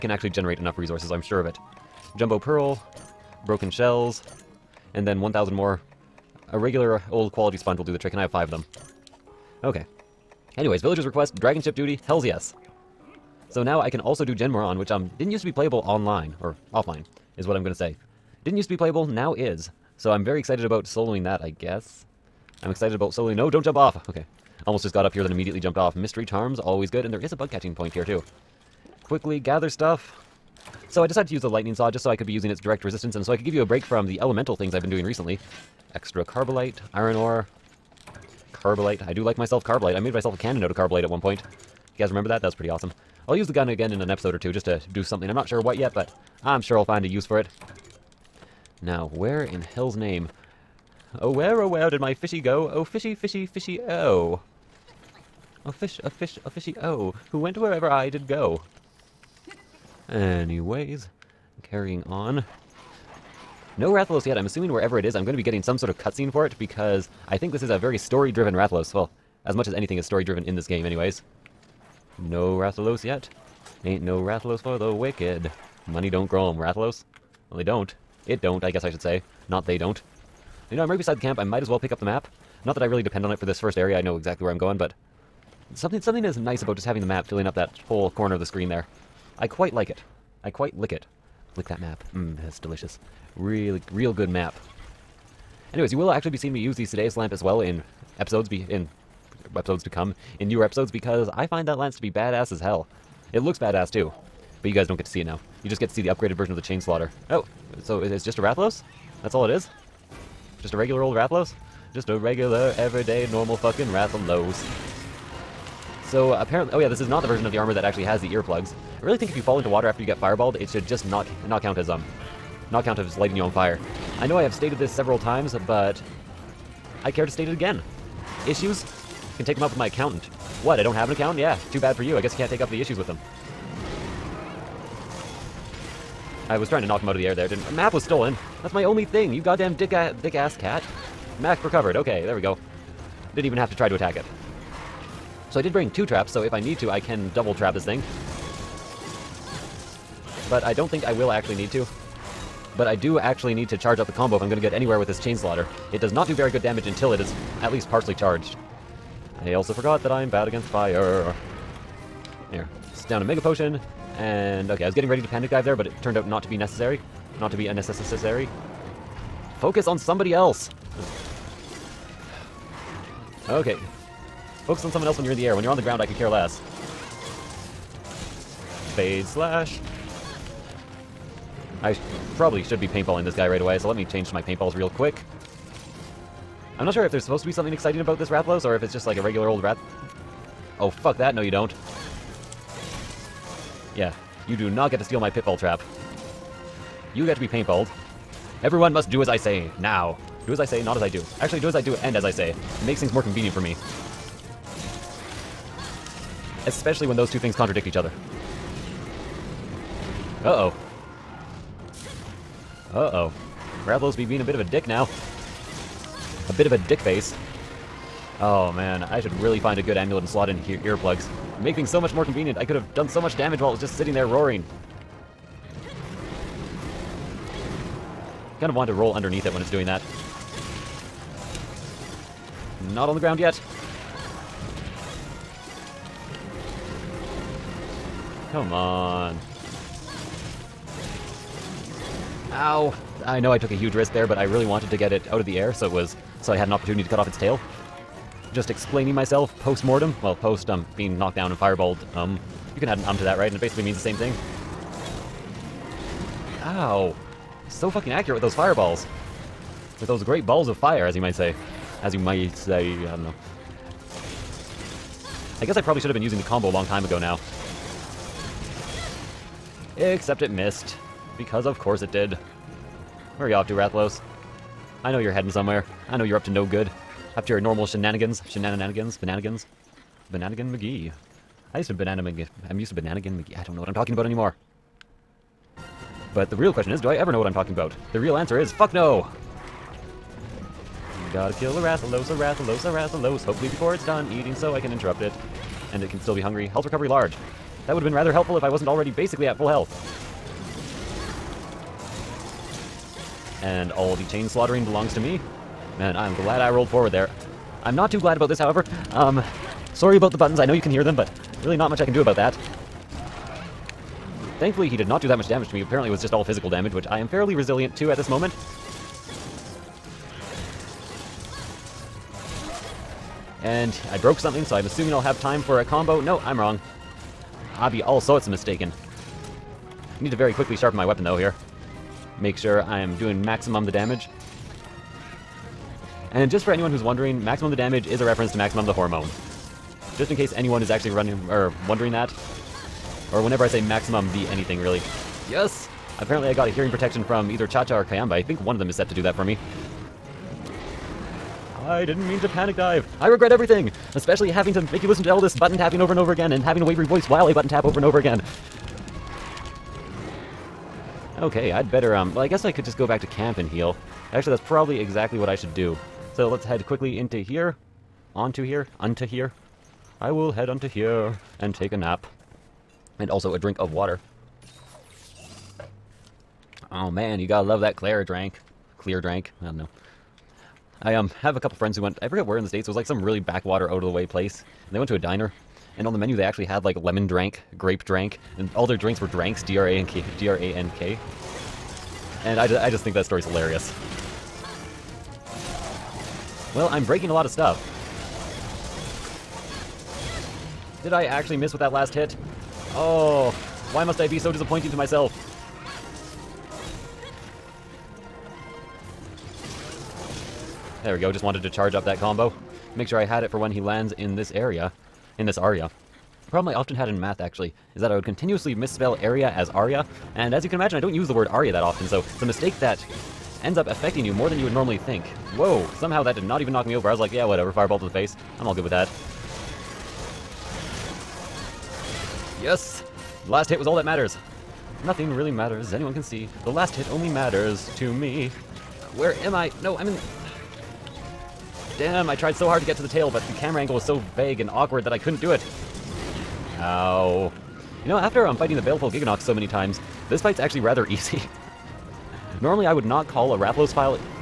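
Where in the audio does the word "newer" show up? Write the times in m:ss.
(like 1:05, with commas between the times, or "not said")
1:40.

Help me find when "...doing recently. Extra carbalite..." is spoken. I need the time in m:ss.
0:34.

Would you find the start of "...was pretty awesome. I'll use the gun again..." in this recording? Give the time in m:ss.
0:42.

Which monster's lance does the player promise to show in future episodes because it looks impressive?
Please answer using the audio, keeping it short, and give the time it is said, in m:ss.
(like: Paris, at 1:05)
Ceadeus, at 1:36.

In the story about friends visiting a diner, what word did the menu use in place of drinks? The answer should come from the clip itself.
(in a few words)
dranks.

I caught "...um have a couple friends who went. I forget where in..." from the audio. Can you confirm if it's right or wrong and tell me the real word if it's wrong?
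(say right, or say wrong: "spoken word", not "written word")
right.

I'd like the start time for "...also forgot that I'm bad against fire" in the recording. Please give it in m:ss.
2:39.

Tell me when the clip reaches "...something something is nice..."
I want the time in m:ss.
1:25.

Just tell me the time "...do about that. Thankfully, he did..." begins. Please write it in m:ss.
5:12.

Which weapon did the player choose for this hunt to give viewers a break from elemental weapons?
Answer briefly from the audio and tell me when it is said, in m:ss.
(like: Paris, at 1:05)
lightning saw, at 0:31.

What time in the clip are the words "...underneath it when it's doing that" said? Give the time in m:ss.
3:49.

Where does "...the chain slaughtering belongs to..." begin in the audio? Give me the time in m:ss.
5:04.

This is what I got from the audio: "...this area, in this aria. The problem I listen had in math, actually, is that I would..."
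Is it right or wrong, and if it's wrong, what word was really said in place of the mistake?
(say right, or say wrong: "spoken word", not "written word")
wrong: "often", not "listen".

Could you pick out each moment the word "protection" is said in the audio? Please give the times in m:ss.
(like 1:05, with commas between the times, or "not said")
5:46.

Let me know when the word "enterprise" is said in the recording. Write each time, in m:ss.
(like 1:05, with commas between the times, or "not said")
not said.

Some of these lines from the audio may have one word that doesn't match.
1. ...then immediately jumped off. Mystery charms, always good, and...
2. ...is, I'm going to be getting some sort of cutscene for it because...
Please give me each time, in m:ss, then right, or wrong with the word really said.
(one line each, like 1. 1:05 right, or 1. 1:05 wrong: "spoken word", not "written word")
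1. 0:25 right
2. 1:05 right.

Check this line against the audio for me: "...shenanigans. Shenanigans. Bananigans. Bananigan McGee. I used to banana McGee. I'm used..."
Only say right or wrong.
right.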